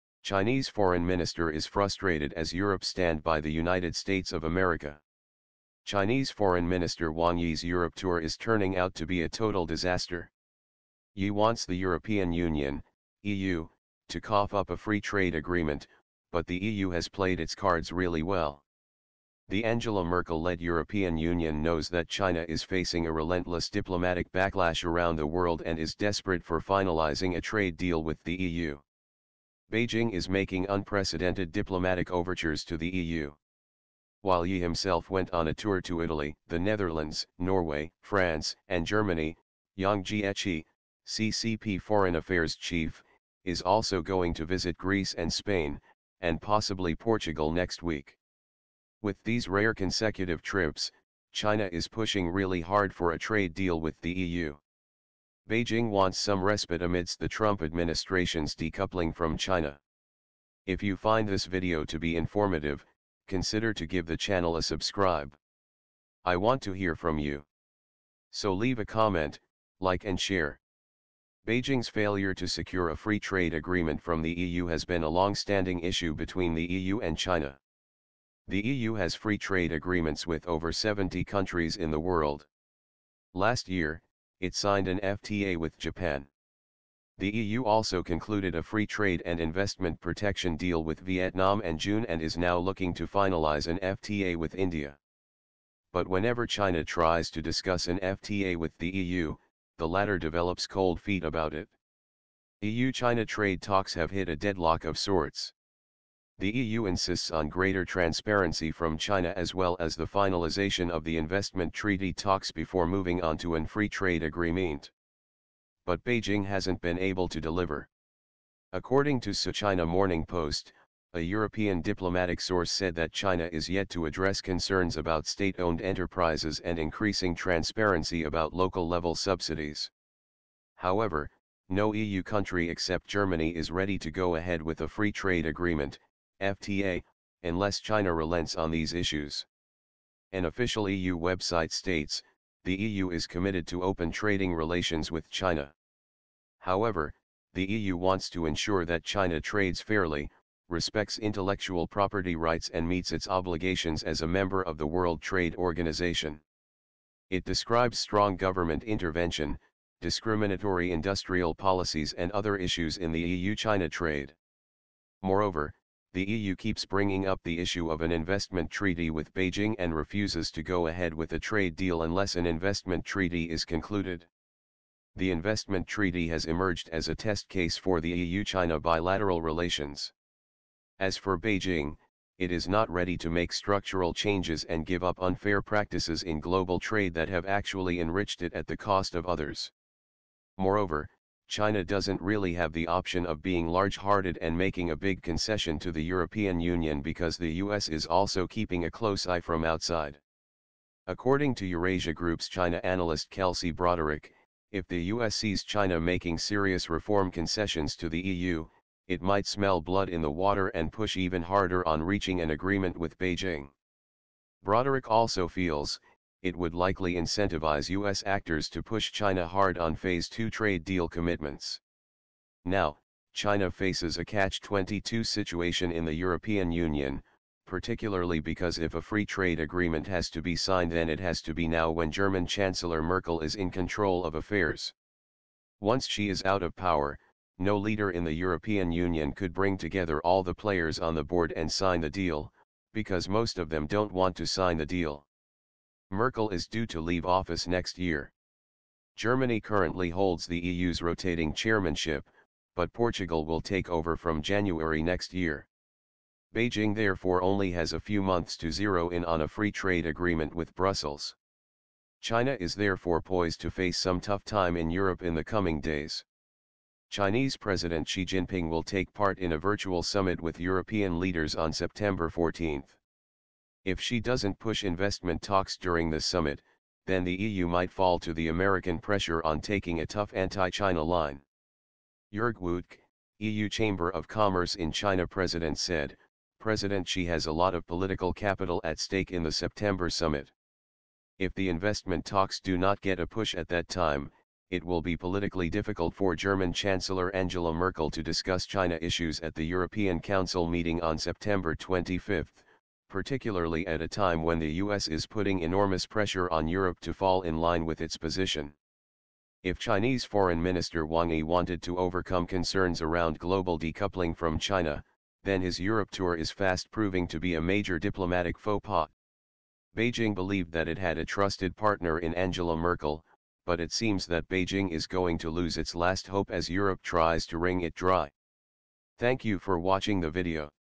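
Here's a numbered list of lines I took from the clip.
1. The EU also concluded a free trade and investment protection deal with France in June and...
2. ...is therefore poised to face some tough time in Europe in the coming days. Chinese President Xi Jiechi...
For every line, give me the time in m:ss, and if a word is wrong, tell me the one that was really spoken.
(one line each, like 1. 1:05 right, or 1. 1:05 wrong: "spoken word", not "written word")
1. 1:27 wrong: "Vietnam", not "France"
2. 4:22 wrong: "Jinping", not "Jiechi".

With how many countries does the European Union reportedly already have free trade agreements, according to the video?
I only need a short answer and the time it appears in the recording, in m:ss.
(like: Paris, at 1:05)
over 70, at 1:20.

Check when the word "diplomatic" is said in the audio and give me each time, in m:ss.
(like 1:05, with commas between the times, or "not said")
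0:23, 0:31, 2:01, 5:17.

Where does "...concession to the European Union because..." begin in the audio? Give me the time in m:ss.
3:15.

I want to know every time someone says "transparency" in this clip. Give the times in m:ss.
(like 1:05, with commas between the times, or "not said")
1:47, 2:07.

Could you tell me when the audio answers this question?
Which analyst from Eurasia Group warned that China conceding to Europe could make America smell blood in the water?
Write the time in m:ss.
3:23.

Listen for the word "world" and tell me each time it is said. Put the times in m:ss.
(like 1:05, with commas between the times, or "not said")
0:25, 1:21, 2:34.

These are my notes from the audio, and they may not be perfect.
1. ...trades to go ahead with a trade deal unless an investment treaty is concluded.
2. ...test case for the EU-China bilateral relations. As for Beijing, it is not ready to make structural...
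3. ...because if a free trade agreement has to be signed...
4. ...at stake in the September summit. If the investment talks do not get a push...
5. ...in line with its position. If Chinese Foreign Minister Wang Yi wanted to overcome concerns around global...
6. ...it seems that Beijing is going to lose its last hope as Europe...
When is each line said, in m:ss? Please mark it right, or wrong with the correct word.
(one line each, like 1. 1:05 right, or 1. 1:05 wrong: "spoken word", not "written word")
1. 2:49 wrong: "refuses", not "trades"
2. 2:57 right
3. 3:48 right
4. 4:48 right
5. 5:07 right
6. 5:23 right.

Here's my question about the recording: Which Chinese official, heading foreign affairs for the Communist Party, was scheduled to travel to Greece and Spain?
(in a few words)
Yang Jiechi.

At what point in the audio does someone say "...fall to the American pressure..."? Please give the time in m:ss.
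4:37.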